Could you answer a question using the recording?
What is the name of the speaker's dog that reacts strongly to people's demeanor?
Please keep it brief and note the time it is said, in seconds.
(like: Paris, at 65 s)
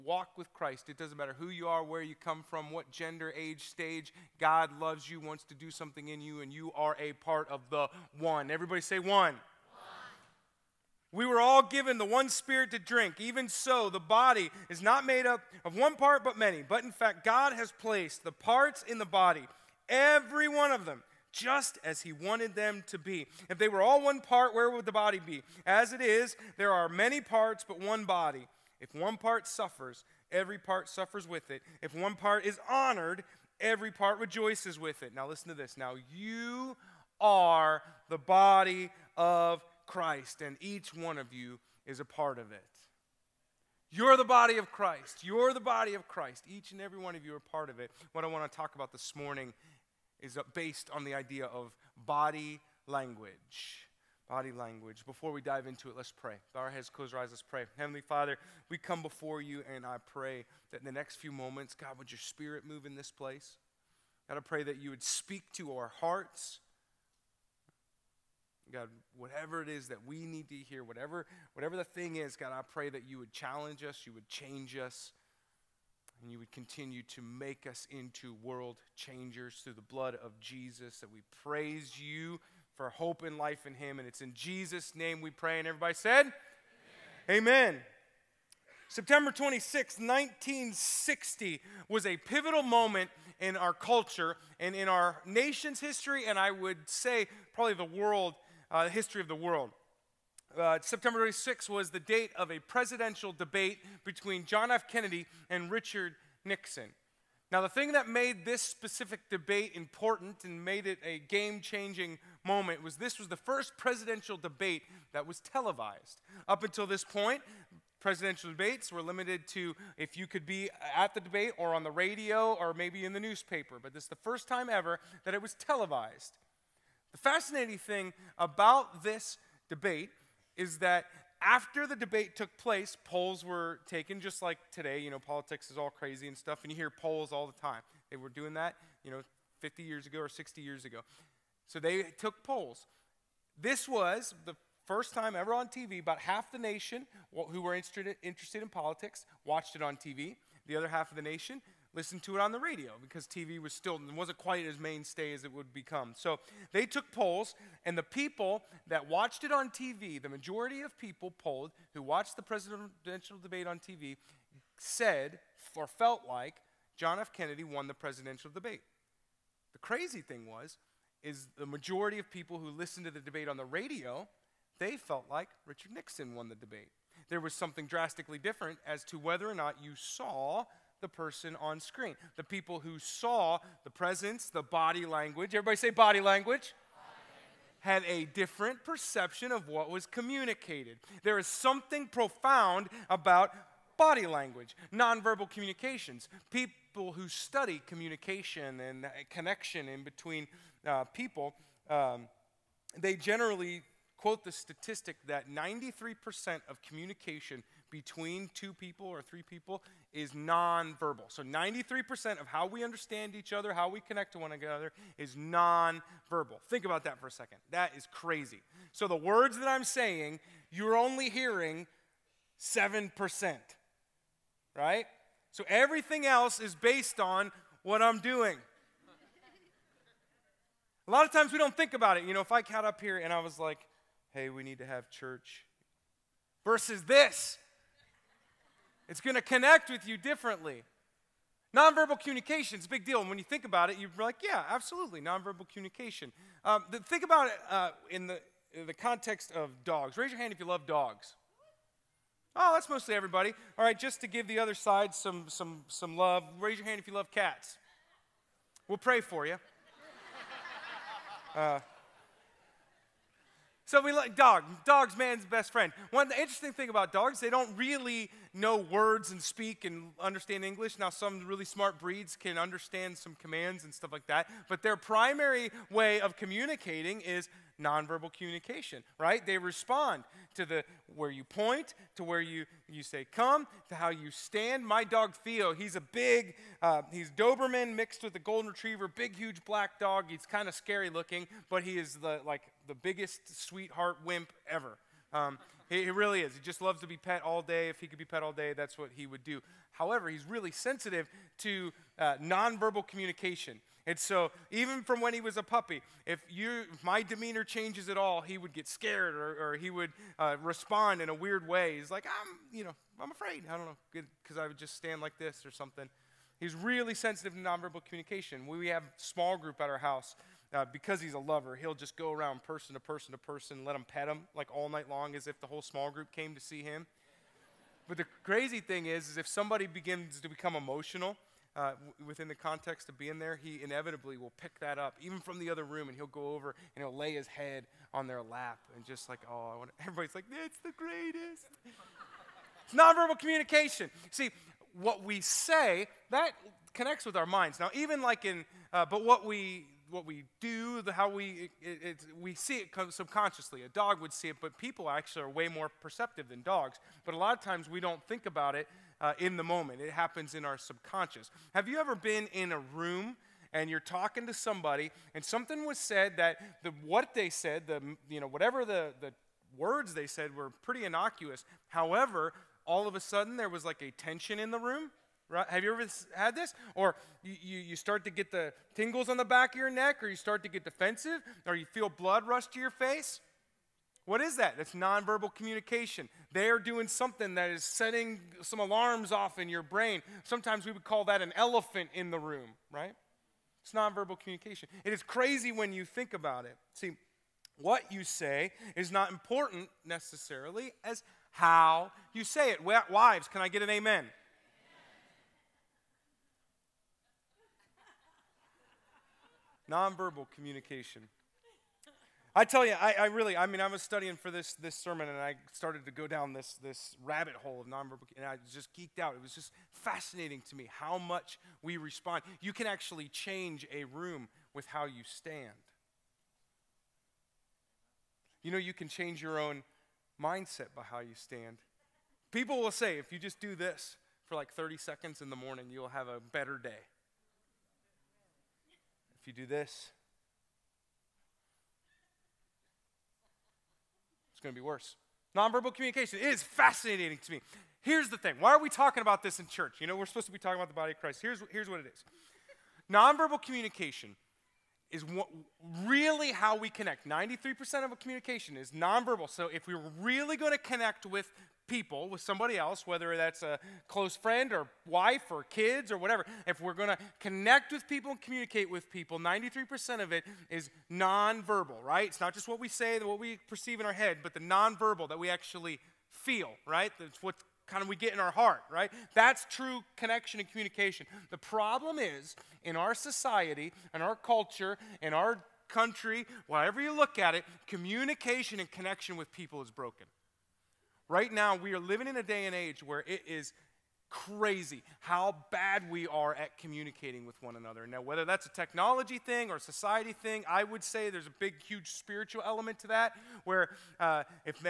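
Theo, at 285 s.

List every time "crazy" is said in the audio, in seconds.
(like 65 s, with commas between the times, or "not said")
135 s, 169 s, 218 s, 328 s, 395 s, 494 s.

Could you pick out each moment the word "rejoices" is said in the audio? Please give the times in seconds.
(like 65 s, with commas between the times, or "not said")
34 s.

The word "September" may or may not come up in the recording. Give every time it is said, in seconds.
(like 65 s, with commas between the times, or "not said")
88 s, 100 s.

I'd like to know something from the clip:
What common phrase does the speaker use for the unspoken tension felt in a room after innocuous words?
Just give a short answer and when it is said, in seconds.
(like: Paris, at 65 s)
Elephant in the room, at 391 s.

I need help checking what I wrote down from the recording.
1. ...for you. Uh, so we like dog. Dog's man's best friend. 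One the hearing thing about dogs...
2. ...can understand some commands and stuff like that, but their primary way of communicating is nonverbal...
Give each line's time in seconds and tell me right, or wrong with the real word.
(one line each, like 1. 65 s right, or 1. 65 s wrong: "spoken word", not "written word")
1. 259 s wrong: "interesting", not "hearing"
2. 272 s right.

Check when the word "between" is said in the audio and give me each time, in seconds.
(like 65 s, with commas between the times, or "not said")
104 s, 200 s, 207 s.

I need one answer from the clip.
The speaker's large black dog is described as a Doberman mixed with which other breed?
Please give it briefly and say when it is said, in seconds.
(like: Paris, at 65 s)
Golden retriever, at 288 s.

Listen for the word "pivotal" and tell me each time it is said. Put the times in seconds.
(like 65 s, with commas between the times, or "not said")
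92 s.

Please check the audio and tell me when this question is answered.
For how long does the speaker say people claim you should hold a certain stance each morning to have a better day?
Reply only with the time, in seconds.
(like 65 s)
434 s.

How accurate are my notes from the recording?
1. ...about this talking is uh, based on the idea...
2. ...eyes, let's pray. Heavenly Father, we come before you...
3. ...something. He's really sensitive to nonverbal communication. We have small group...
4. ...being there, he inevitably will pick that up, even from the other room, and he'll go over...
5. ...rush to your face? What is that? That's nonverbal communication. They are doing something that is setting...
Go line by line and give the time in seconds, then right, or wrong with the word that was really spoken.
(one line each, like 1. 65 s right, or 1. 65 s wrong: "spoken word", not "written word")
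1. 48 s wrong: "morning", not "talking"
2. 57 s right
3. 315 s right
4. 333 s right
5. 382 s right.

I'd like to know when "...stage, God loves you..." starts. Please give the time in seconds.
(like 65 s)
3 s.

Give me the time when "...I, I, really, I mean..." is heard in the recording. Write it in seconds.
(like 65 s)
412 s.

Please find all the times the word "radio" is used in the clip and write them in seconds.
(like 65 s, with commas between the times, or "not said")
121 s, 152 s, 173 s.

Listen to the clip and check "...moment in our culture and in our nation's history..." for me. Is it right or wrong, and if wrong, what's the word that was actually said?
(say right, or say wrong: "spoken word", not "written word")
right.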